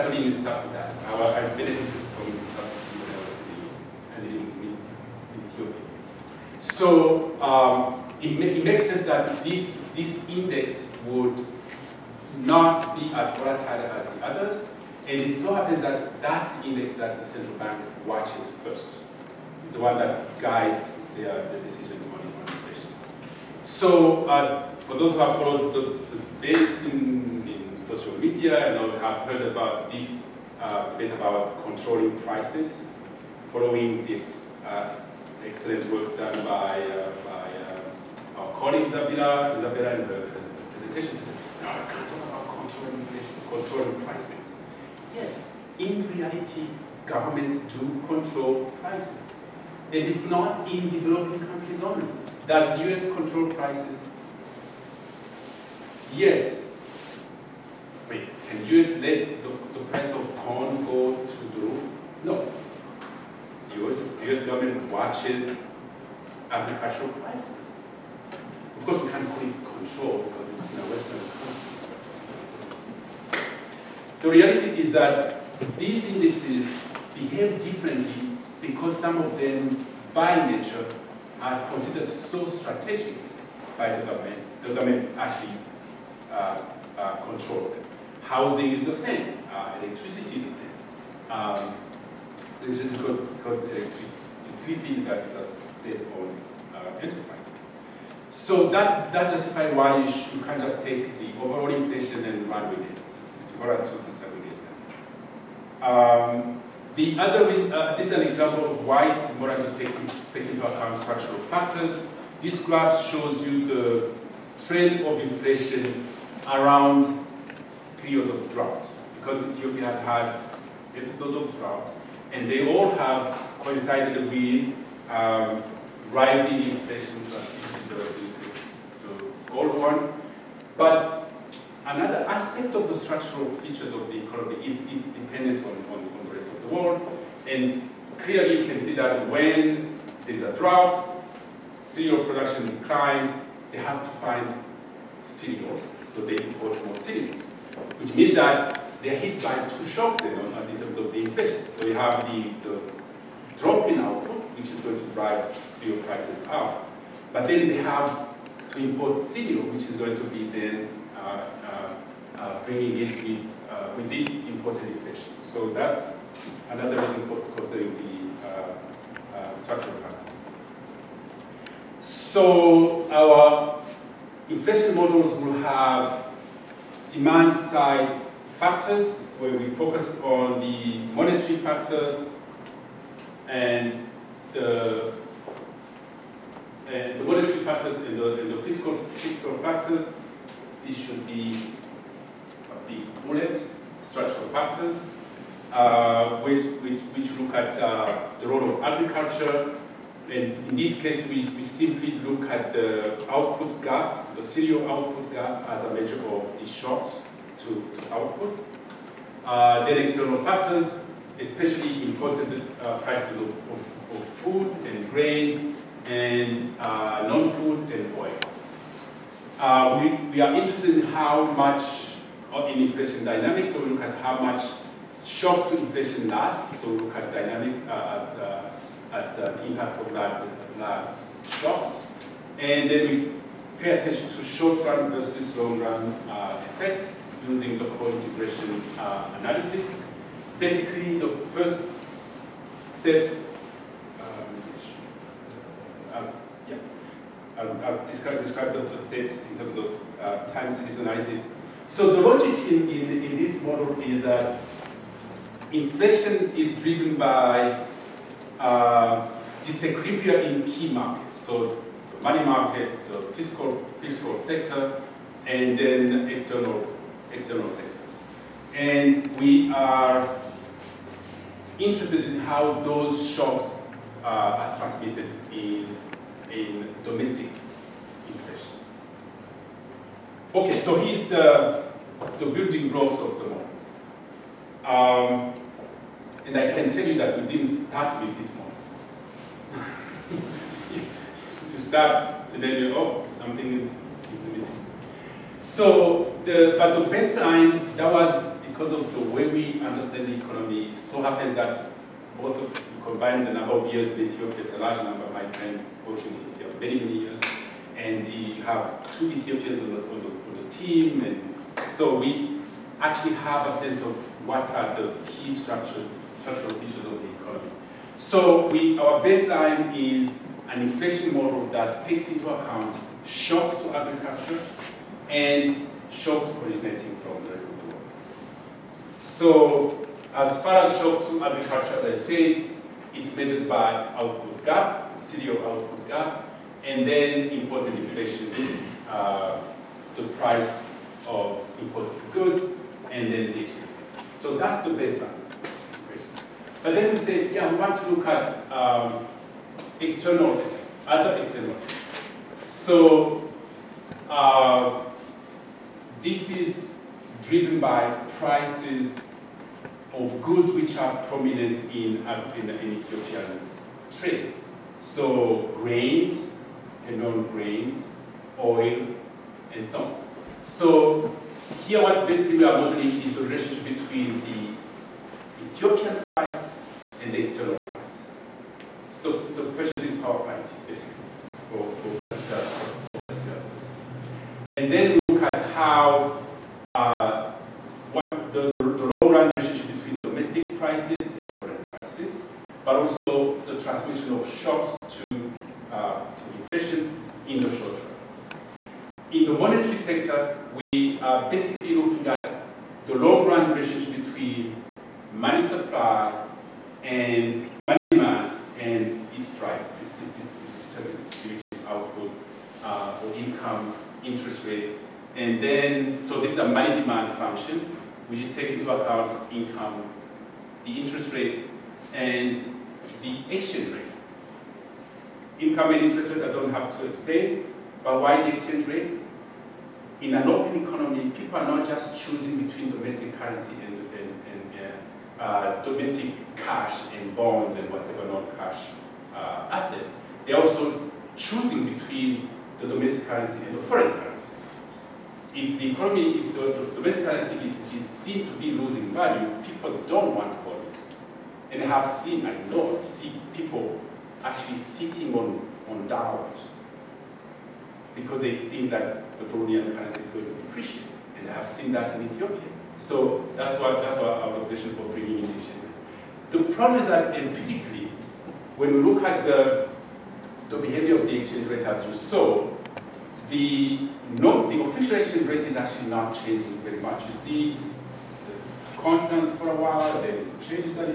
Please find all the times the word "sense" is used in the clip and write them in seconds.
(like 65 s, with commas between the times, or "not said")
8 s, 313 s.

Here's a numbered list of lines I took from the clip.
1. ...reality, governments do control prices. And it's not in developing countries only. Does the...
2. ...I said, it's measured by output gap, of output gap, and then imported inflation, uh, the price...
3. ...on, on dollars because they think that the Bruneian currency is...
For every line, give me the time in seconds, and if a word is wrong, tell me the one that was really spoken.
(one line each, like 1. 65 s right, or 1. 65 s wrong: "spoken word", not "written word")
1. 46 s right
2. 332 s right
3. 455 s right.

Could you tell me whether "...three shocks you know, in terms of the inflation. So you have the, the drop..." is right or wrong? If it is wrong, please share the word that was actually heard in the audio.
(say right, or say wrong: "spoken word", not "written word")
wrong: "two", not "three".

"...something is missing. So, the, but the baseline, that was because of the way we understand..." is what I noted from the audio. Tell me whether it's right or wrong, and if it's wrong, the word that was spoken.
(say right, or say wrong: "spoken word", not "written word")
right.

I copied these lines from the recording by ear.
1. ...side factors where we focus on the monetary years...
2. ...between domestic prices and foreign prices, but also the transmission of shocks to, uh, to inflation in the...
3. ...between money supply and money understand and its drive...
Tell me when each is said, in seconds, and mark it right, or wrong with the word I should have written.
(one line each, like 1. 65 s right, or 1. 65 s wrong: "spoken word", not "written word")
1. 177 s wrong: "factors", not "years"
2. 389 s right
3. 404 s wrong: "demand", not "understand".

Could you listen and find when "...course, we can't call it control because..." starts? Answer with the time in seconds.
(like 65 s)
68 s.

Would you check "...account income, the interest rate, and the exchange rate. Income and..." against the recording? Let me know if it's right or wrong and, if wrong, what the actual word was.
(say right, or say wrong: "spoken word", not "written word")
right.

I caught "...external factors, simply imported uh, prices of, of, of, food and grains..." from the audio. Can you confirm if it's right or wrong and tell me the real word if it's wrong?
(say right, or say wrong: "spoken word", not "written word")
wrong: "especially", not "simply".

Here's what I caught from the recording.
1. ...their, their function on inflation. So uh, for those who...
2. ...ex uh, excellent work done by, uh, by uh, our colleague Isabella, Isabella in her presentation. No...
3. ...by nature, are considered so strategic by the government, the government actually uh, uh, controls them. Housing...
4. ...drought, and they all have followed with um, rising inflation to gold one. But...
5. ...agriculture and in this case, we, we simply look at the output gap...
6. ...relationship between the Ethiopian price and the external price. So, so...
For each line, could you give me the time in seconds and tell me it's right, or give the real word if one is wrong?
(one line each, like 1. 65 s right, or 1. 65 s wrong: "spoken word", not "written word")
1. 21 s wrong: "decision", not "function"
2. 34 s right
3. 80 s right
4. 121 s wrong: "coincided", not "followed"
5. 198 s right
6. 373 s right.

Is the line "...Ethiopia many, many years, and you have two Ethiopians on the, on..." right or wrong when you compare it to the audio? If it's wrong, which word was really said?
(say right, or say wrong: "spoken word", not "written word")
right.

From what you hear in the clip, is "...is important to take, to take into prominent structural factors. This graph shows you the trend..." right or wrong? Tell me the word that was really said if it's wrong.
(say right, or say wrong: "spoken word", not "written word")
wrong: "account", not "prominent".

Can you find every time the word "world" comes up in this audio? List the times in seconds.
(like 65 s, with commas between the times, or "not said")
136 s, 327 s.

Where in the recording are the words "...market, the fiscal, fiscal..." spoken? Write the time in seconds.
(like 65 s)
262 s.